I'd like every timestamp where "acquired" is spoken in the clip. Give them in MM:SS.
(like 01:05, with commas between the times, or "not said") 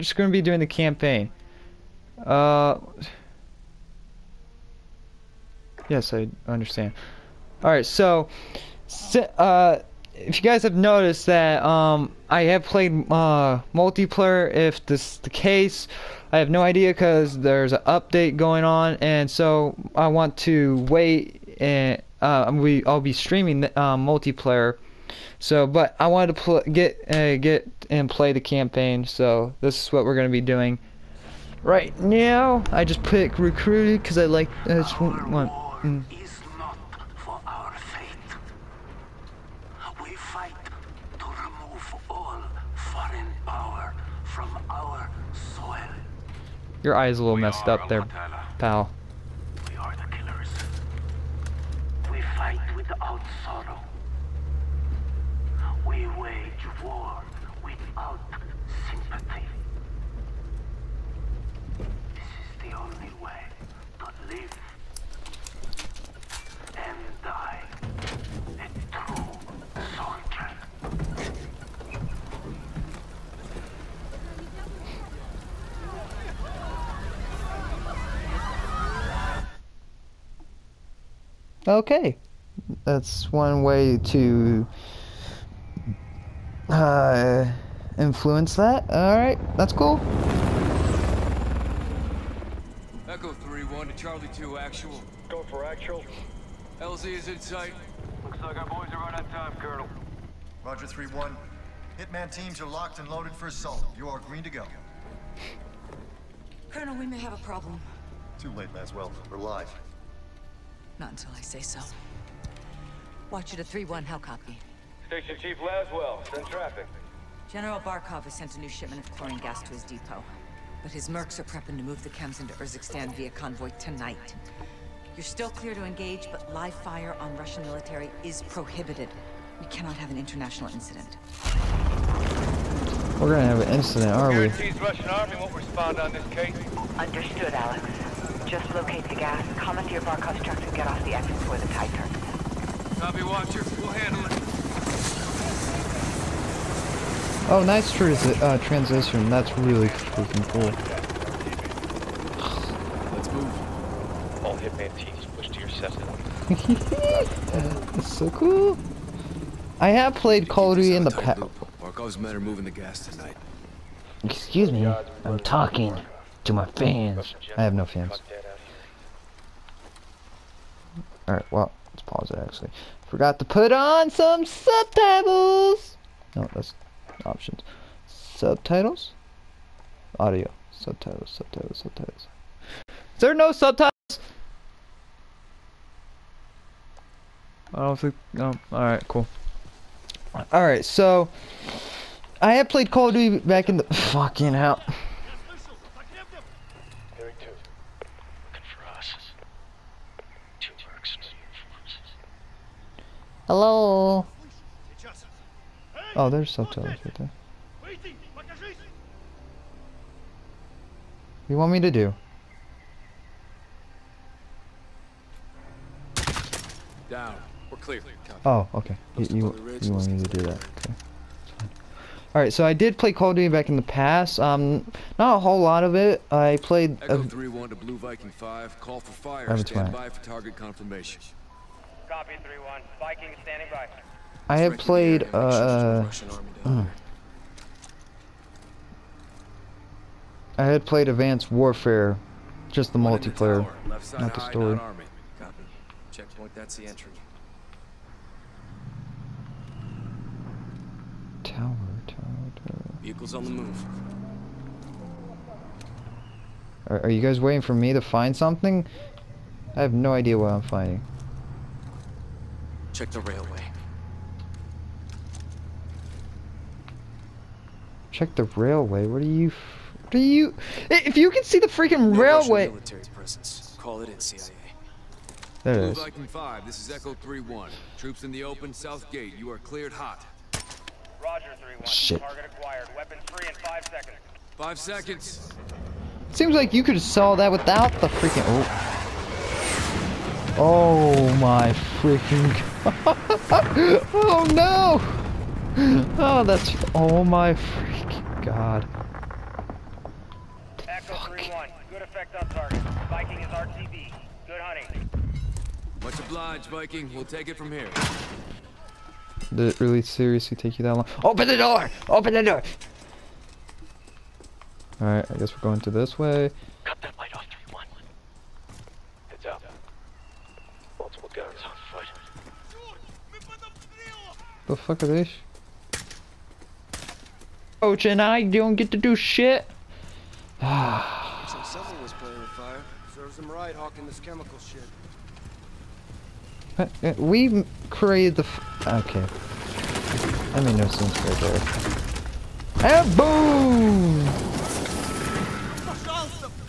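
04:42.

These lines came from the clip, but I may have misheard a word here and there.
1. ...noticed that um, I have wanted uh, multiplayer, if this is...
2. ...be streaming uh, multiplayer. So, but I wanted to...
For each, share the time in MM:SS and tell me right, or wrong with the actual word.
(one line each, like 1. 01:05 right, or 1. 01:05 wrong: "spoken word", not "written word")
1. 00:10 wrong: "played", not "wanted"
2. 00:23 right.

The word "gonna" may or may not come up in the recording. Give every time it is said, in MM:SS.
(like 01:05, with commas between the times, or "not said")
00:00, 00:30, 02:13.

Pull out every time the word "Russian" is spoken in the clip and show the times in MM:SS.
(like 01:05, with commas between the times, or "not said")
02:07, 02:14.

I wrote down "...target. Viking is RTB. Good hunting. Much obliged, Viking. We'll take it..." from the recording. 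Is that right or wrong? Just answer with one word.
right.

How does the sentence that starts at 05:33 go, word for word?
Serves him right hawking this chemical shit.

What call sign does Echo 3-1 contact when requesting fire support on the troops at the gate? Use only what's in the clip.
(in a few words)
Viking 5.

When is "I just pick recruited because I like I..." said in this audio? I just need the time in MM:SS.
00:32.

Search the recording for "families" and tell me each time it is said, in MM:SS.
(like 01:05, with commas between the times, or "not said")
not said.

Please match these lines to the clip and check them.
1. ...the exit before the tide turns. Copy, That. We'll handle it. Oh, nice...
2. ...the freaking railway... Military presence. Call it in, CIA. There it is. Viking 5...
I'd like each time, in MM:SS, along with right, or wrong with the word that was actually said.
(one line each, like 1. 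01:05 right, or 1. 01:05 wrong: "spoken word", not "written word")
1. 02:21 wrong: "Watcher", not "That"
2. 04:31 right.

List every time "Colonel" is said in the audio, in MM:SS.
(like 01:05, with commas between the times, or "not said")
01:39, 01:46.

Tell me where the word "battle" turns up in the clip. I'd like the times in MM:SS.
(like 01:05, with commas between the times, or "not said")
not said.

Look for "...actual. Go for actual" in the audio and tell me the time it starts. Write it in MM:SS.
01:34.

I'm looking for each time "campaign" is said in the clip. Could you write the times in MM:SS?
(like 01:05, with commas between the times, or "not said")
00:00, 00:28.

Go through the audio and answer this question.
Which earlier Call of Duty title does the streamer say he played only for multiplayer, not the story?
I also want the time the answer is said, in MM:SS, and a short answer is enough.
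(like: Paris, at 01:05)
Advanced Warfare, at 04:01.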